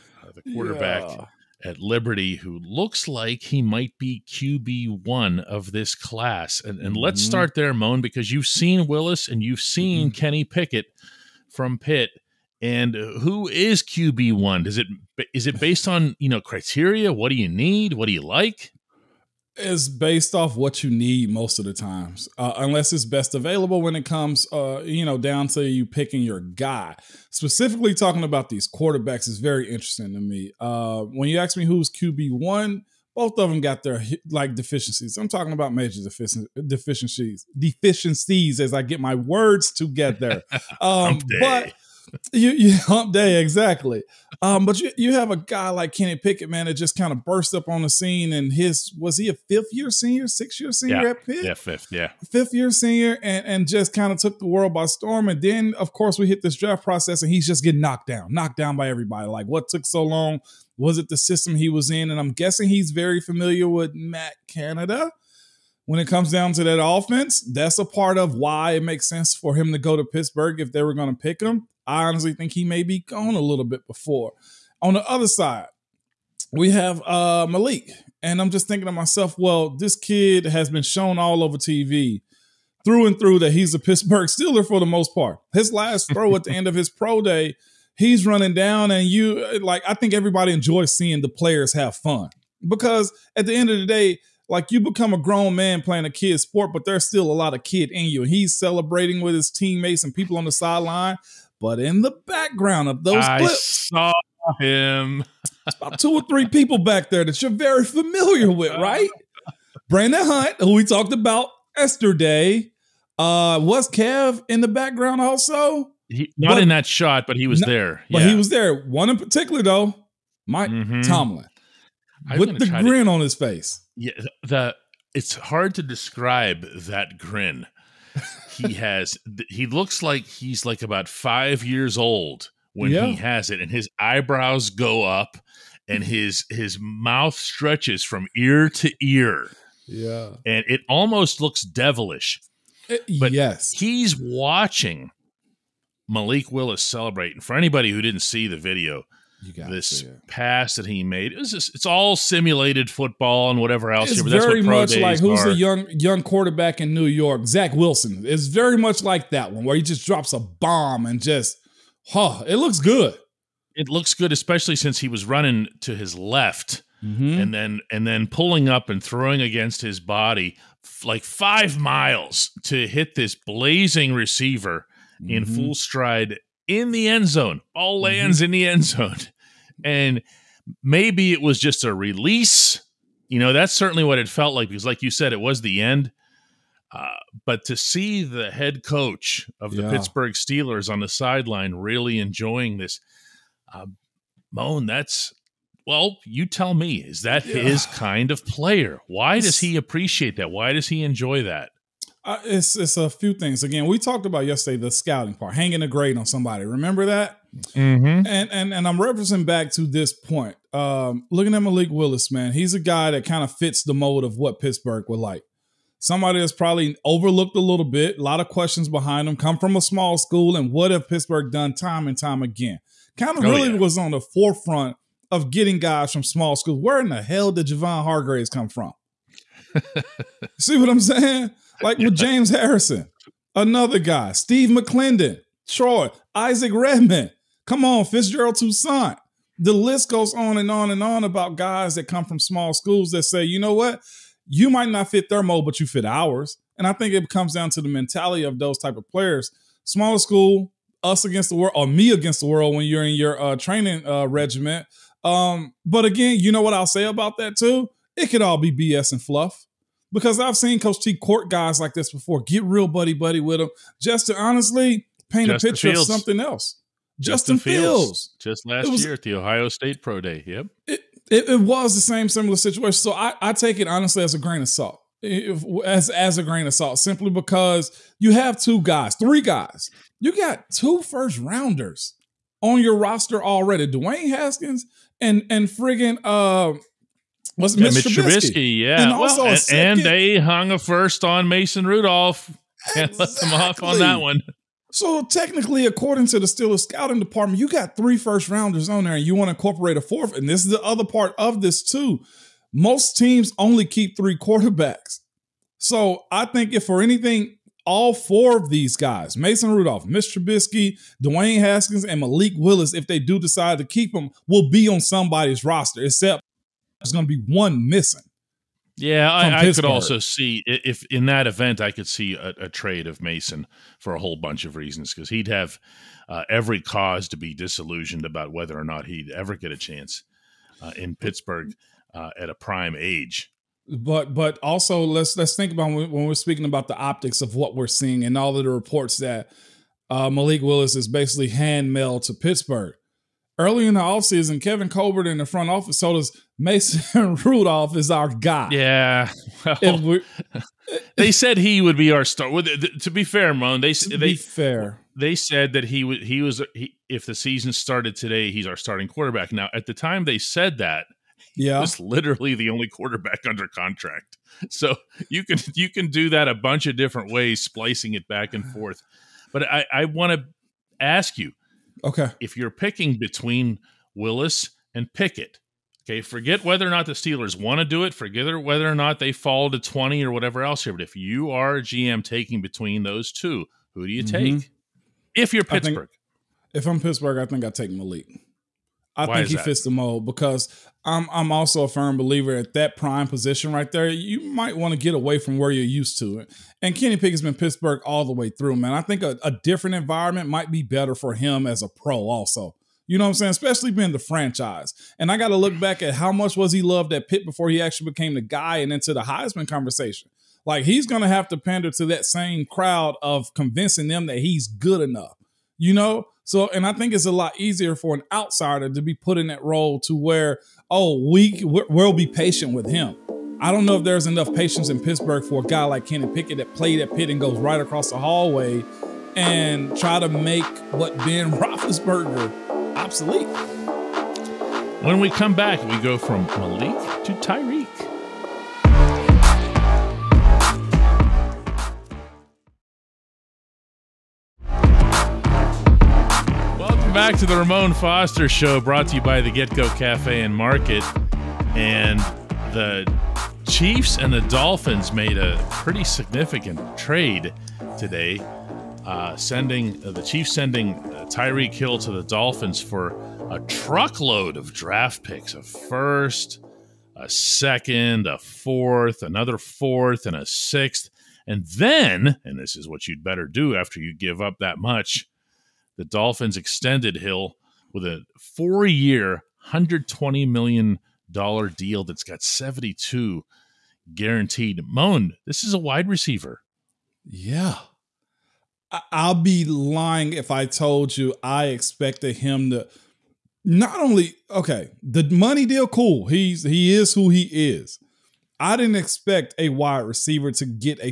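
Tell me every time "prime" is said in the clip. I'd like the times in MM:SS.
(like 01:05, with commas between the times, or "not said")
05:32, 06:32.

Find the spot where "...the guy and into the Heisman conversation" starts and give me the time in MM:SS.
06:48.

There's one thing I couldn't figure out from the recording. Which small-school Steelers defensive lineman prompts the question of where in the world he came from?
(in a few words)
Javon Hargraves.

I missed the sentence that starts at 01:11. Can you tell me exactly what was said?
I honestly think he may be gone a little bit before.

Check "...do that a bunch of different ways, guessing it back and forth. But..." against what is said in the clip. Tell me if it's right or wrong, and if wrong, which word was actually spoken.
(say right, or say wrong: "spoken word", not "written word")
wrong: "splicing", not "guessing".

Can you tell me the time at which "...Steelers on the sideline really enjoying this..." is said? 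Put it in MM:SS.
03:10.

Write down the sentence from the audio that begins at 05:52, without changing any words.
To be fair, Moan, they they fair.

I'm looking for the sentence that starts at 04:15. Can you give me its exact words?
Um, but again, you know what I'll say about that too?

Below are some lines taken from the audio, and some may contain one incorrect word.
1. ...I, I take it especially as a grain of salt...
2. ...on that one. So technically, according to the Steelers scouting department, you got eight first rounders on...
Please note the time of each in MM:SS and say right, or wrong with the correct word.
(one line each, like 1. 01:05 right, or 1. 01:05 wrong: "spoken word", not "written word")
1. 04:33 wrong: "honestly", not "especially"
2. 04:53 wrong: "three", not "eight".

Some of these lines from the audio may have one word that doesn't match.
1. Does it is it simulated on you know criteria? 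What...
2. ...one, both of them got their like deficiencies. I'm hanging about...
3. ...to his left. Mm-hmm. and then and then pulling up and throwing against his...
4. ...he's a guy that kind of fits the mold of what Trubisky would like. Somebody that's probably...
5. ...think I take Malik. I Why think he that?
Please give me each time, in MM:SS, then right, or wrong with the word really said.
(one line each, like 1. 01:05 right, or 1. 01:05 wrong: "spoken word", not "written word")
1. 00:14 wrong: "based", not "simulated"
2. 00:32 wrong: "talking", not "hanging"
3. 02:45 right
4. 03:32 wrong: "Pittsburgh", not "Trubisky"
5. 06:27 right.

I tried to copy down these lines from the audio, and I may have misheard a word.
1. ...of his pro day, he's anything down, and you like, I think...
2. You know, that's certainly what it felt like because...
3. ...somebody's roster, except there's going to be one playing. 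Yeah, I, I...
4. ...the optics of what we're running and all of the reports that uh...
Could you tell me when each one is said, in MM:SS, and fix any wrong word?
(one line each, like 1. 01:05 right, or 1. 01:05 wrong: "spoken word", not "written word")
1. 01:26 wrong: "running", not "anything"
2. 03:03 right
3. 05:14 wrong: "missing", not "playing"
4. 05:36 wrong: "seeing", not "running".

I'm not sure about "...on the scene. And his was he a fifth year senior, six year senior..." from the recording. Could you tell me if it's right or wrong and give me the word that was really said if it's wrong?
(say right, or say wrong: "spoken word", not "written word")
right.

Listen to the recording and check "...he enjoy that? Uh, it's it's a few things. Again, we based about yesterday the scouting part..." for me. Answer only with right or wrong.
wrong.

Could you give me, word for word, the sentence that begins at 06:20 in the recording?
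But if you are a GM taking between those two, who do you mm-hmm.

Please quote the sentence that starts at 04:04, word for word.
You might not fit their mold, but you fit ours.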